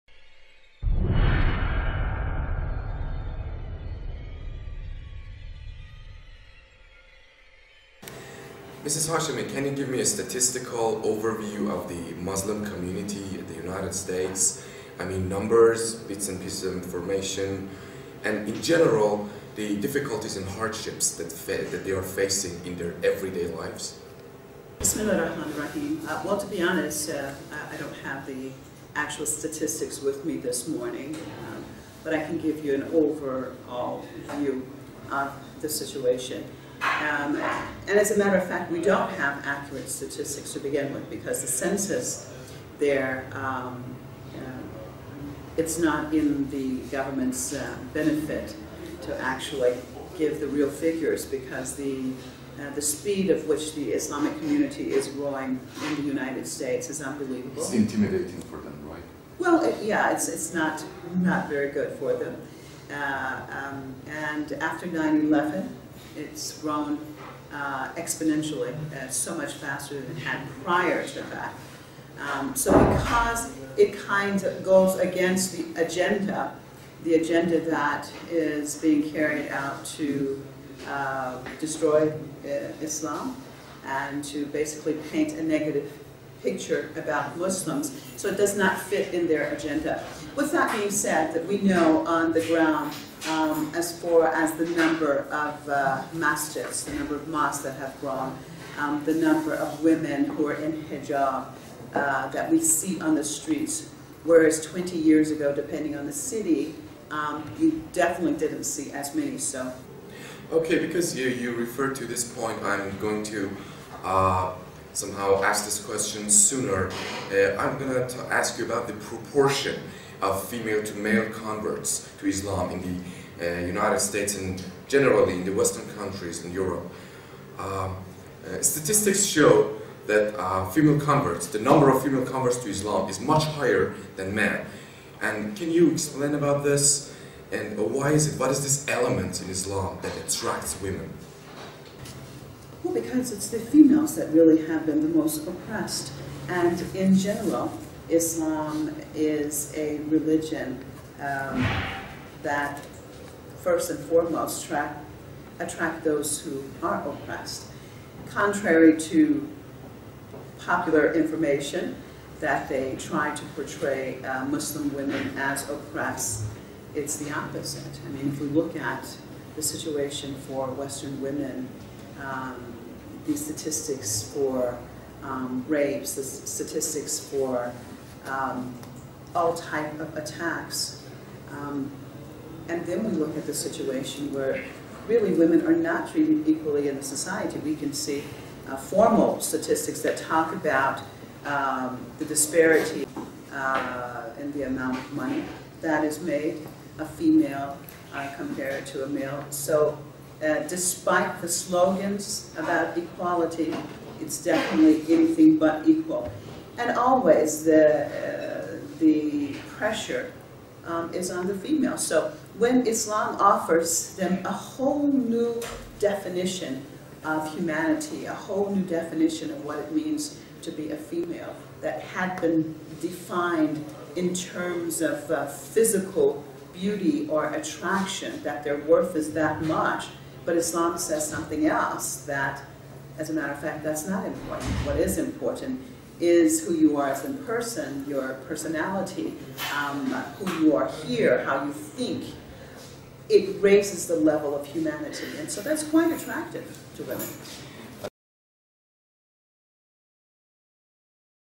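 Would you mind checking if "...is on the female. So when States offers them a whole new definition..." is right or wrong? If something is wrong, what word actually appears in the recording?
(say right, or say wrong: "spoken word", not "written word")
wrong: "Islam", not "States".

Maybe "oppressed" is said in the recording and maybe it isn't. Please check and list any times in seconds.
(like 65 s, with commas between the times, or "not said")
145 s, 157 s, 165 s.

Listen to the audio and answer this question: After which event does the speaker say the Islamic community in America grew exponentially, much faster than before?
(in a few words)
9/11.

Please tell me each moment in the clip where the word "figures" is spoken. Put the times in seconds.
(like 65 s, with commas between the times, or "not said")
50 s.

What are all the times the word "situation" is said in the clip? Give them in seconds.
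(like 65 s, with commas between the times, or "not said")
35 s, 169 s, 183 s.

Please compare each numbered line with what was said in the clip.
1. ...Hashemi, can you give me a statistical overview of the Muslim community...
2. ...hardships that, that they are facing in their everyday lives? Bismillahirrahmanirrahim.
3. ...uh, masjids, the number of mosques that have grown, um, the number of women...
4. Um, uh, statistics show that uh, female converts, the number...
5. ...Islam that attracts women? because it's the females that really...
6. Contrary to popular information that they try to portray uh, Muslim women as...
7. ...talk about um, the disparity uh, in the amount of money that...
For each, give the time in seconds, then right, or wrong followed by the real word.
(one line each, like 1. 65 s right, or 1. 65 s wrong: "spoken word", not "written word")
1. 9 s right
2. 20 s right
3. 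95 s right
4. 127 s right
5. 139 s right
6. 158 s right
7. 190 s right.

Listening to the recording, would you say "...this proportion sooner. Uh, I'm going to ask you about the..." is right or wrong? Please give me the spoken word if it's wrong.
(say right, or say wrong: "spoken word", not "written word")
wrong: "question", not "proportion".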